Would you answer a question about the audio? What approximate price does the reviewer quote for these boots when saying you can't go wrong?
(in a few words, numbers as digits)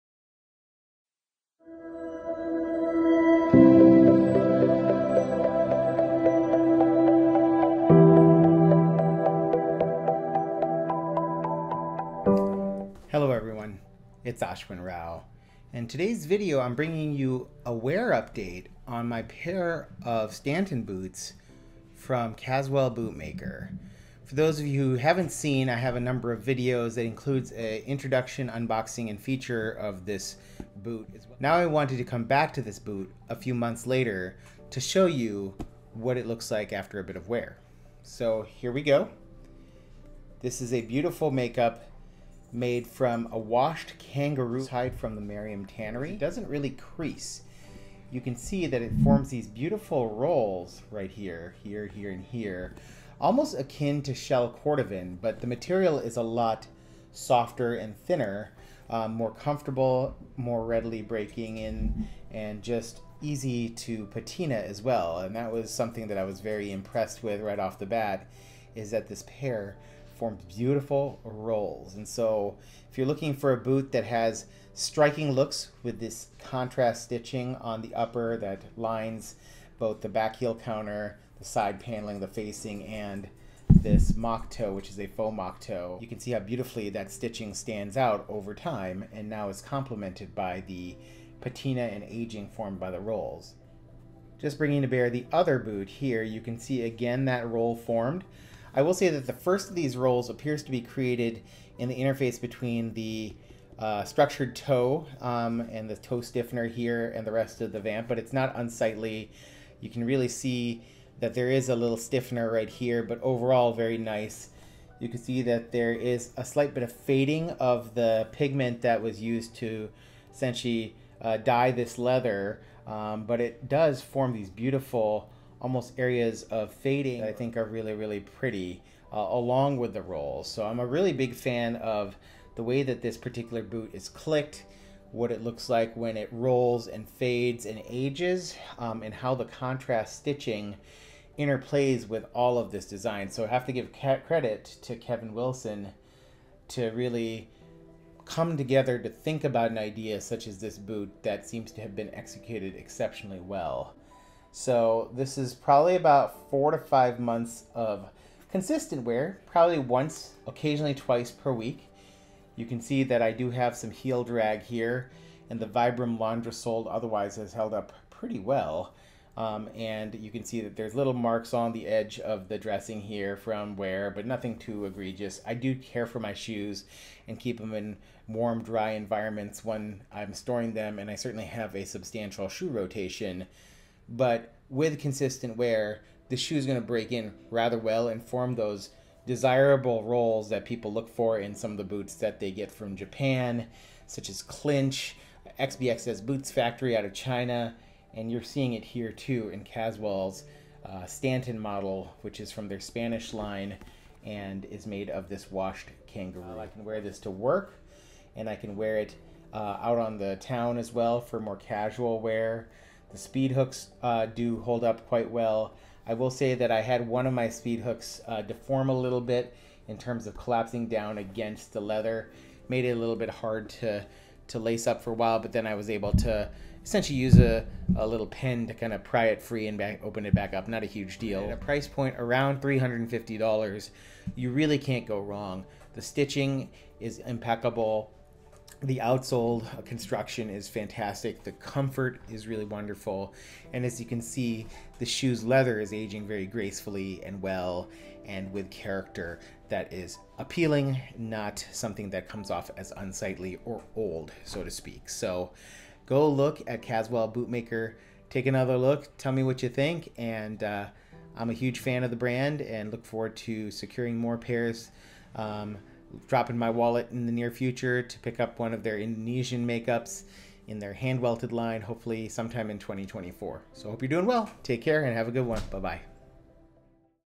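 $350.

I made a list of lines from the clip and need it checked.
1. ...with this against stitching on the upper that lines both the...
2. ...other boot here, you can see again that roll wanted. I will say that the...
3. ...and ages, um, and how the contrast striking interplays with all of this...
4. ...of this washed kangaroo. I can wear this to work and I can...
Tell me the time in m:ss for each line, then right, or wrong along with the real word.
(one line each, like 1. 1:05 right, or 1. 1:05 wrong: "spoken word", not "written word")
1. 1:15 wrong: "contrast", not "against"
2. 1:35 wrong: "formed", not "wanted"
3. 2:17 wrong: "stitching", not "striking"
4. 3:25 right.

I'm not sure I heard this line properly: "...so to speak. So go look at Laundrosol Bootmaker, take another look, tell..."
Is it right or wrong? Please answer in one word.
wrong.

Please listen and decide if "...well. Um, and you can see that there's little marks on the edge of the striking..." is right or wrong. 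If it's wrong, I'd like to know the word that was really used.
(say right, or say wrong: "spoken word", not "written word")
wrong: "dressing", not "striking".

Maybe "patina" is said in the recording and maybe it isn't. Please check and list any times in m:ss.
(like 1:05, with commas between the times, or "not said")
1:04, 1:31.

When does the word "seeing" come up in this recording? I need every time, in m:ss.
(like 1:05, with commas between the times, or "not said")
3:18.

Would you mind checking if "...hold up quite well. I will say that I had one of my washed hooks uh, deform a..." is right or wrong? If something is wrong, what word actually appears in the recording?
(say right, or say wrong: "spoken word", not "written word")
wrong: "speed", not "washed".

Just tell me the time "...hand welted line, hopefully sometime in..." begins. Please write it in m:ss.
4:30.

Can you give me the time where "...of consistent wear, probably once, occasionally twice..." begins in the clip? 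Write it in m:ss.
2:37.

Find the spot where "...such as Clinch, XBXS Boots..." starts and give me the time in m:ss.
3:14.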